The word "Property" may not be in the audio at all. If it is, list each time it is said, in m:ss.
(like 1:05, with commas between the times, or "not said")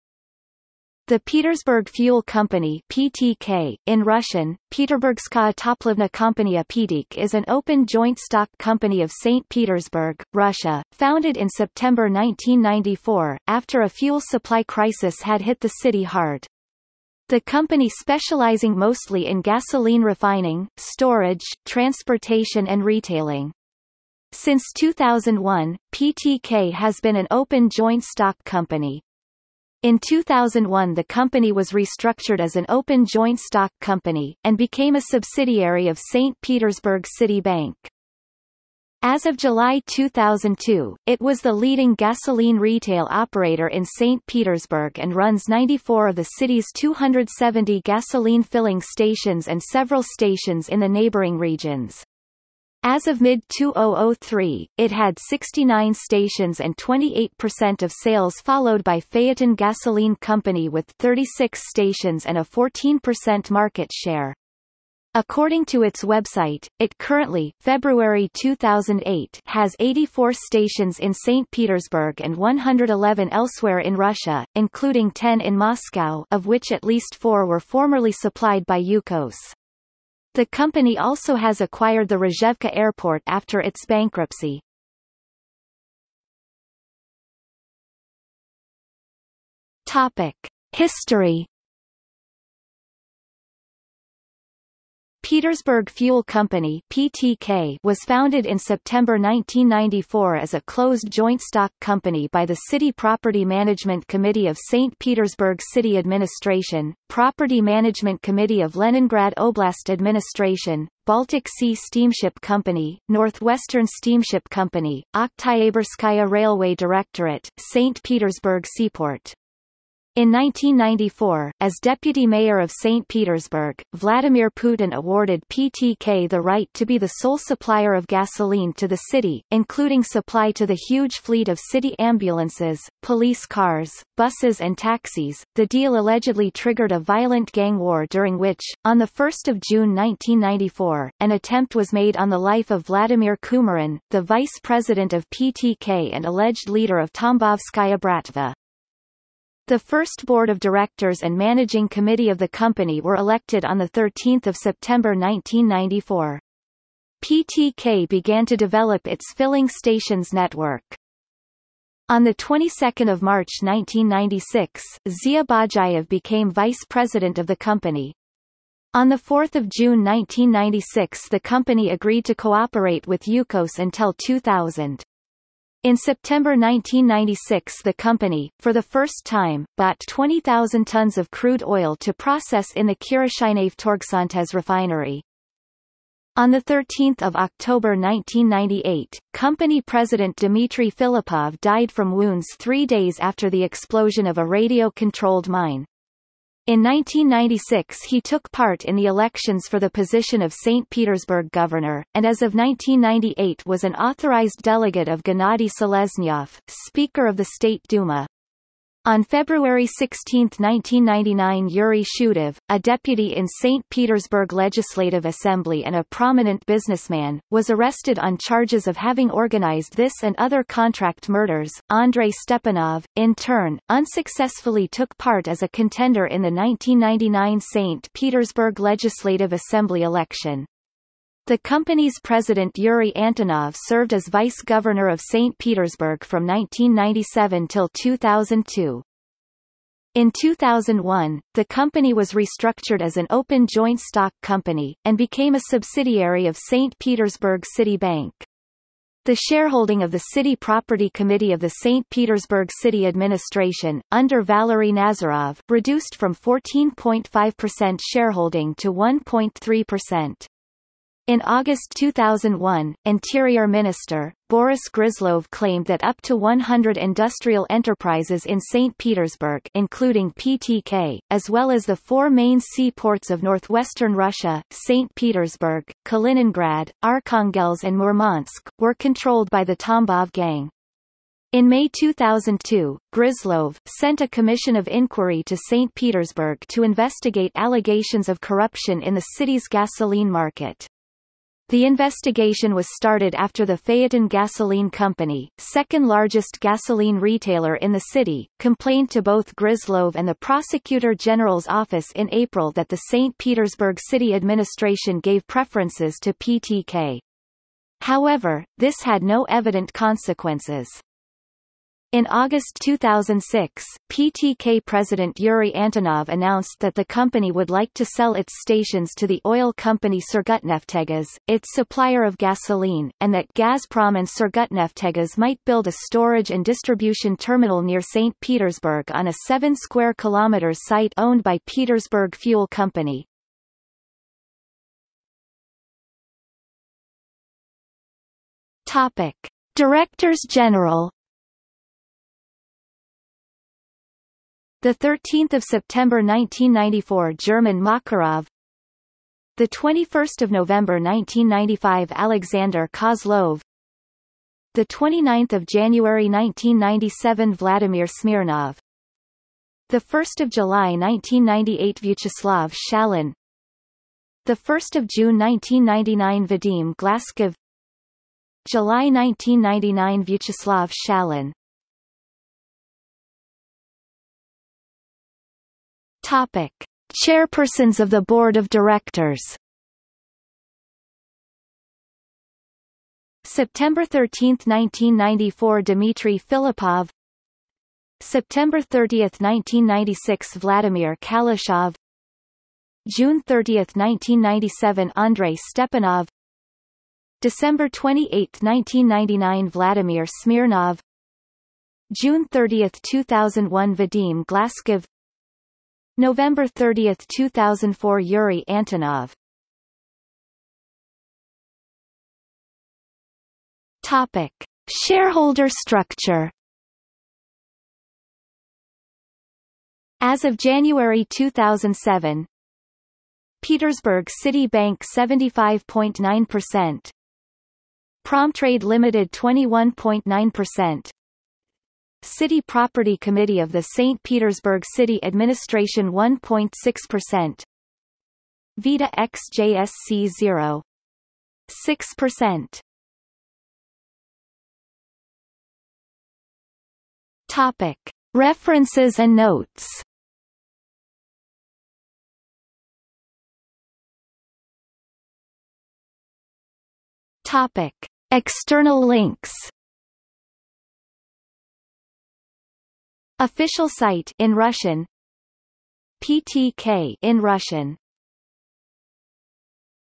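1:42, 1:47, 4:10, 7:12.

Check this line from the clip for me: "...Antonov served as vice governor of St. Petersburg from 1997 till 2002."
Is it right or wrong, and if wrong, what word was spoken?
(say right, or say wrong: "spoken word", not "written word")
right.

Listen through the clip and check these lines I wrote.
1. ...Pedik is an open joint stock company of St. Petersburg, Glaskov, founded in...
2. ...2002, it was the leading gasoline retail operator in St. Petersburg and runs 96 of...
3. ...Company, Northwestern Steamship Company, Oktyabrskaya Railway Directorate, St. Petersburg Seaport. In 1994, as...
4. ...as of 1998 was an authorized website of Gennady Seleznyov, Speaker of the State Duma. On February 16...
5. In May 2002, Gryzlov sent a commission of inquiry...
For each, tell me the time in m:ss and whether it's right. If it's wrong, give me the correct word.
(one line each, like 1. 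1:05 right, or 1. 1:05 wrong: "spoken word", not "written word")
1. 0:06 wrong: "Russia", not "Glaskov"
2. 0:39 wrong: "94", not "96"
3. 1:52 right
4. 3:22 wrong: "delegate", not "website"
5. 4:41 right.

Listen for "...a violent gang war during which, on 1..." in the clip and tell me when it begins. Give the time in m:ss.
2:16.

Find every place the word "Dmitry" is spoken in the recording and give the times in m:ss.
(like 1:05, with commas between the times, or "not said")
3:10, 6:25.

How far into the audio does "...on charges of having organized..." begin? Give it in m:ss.
3:38.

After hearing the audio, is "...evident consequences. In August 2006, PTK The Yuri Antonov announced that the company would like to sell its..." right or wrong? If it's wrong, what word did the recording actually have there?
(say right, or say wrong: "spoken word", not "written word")
wrong: "President", not "The".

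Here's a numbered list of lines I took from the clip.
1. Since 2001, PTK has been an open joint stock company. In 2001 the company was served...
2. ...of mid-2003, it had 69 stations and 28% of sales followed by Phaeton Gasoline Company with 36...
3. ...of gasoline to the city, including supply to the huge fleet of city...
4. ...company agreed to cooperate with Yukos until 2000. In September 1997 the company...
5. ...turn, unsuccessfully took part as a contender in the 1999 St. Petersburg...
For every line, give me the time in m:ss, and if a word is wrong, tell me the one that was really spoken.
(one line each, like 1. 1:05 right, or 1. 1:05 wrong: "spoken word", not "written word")
1. 0:24 wrong: "restructured", not "served"
2. 0:53 right
3. 2:07 right
4. 2:51 wrong: "1996", not "1997"
5. 3:43 right.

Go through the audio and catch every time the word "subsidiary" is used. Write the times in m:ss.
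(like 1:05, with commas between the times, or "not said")
0:35, 4:05.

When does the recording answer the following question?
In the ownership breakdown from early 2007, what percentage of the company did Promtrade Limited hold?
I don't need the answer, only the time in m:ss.
7:09.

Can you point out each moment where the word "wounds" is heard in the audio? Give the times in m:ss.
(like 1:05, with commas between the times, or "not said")
3:12.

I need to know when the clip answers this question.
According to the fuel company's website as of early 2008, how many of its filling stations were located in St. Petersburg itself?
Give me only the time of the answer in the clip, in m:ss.
1:09.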